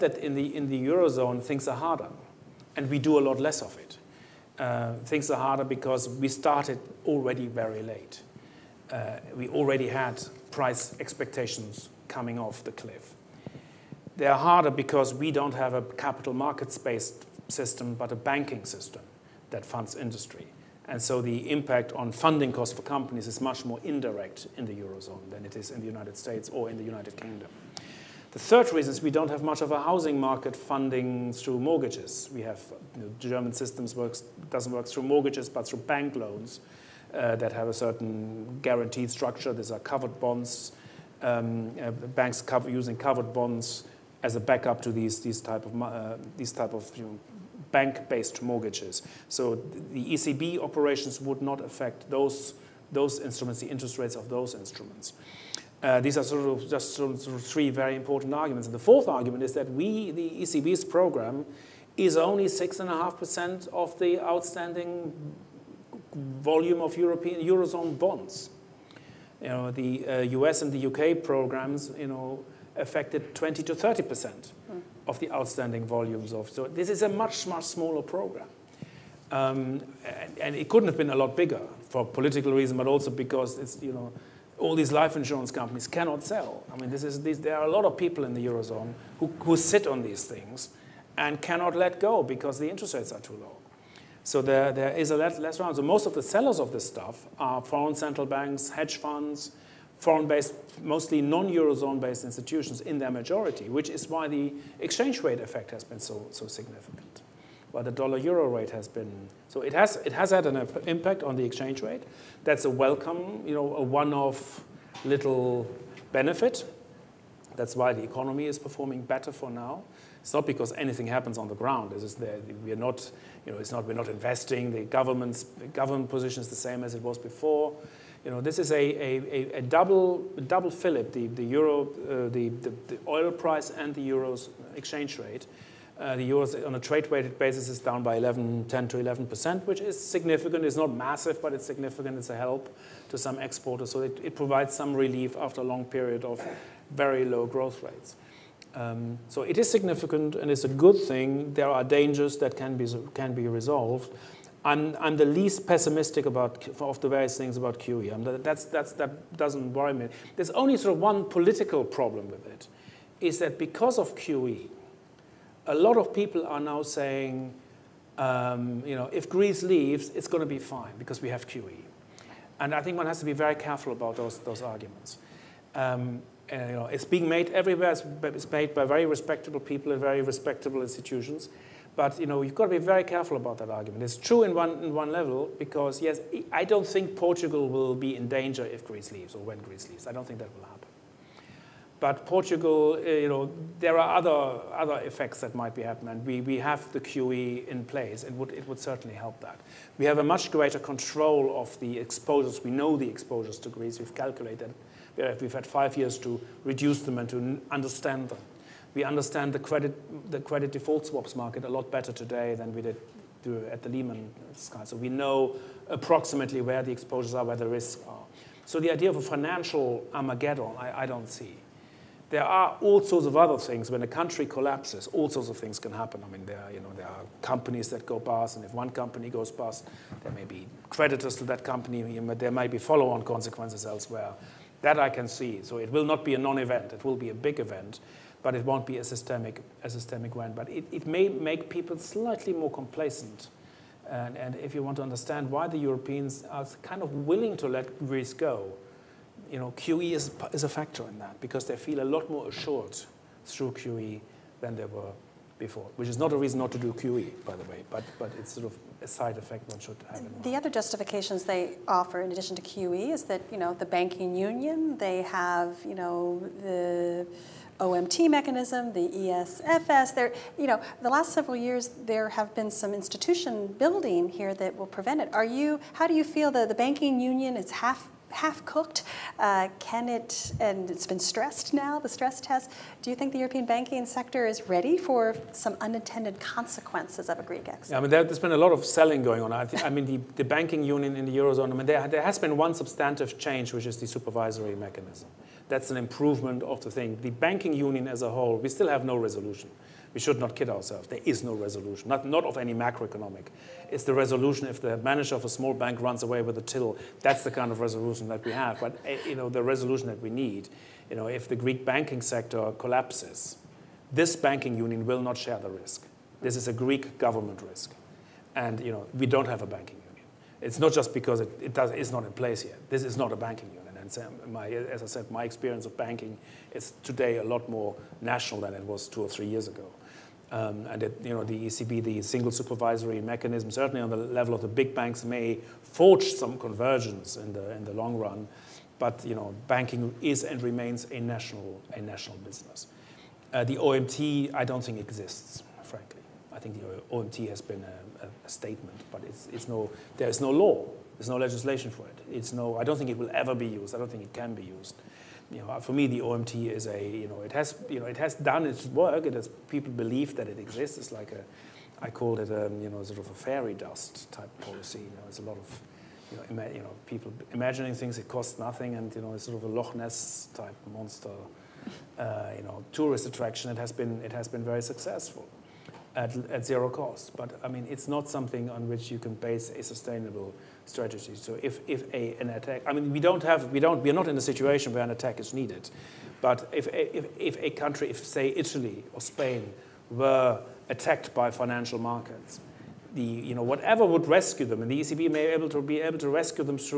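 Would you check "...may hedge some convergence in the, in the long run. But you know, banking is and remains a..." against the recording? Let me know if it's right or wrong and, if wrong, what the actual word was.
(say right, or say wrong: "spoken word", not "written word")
wrong: "forge", not "hedge".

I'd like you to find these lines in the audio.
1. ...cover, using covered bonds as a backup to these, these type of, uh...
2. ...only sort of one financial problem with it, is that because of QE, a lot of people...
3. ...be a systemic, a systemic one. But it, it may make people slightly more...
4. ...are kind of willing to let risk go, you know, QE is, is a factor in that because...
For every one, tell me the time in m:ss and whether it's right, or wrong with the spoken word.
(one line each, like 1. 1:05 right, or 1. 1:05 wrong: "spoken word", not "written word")
1. 0:42 right
2. 2:40 wrong: "political", not "financial"
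3. 3:58 right
4. 4:06 right.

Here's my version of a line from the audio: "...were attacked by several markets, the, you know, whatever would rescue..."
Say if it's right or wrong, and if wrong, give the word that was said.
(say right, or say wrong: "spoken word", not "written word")
wrong: "financial", not "several".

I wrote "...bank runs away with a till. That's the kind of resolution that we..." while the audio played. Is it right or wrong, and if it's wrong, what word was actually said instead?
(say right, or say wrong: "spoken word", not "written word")
right.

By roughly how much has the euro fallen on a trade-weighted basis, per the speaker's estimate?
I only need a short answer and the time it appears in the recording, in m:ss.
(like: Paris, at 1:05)
10 to 11 percent, at 2:18.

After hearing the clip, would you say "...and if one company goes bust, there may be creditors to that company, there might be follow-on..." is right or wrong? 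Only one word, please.
right.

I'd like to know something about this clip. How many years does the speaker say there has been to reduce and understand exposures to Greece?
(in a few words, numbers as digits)
5.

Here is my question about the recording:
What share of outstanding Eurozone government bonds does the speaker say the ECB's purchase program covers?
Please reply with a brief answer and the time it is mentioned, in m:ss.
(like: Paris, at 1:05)
6.5%, at 1:02.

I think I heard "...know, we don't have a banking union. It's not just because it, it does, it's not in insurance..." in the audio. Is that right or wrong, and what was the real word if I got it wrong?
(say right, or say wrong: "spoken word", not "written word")
wrong: "place", not "insurance".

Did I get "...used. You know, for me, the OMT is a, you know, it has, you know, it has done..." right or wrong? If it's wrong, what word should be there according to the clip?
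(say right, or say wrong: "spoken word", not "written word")
right.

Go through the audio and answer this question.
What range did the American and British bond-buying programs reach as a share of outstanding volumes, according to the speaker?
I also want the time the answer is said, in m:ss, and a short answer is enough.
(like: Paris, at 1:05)
20 to 30 percent, at 1:13.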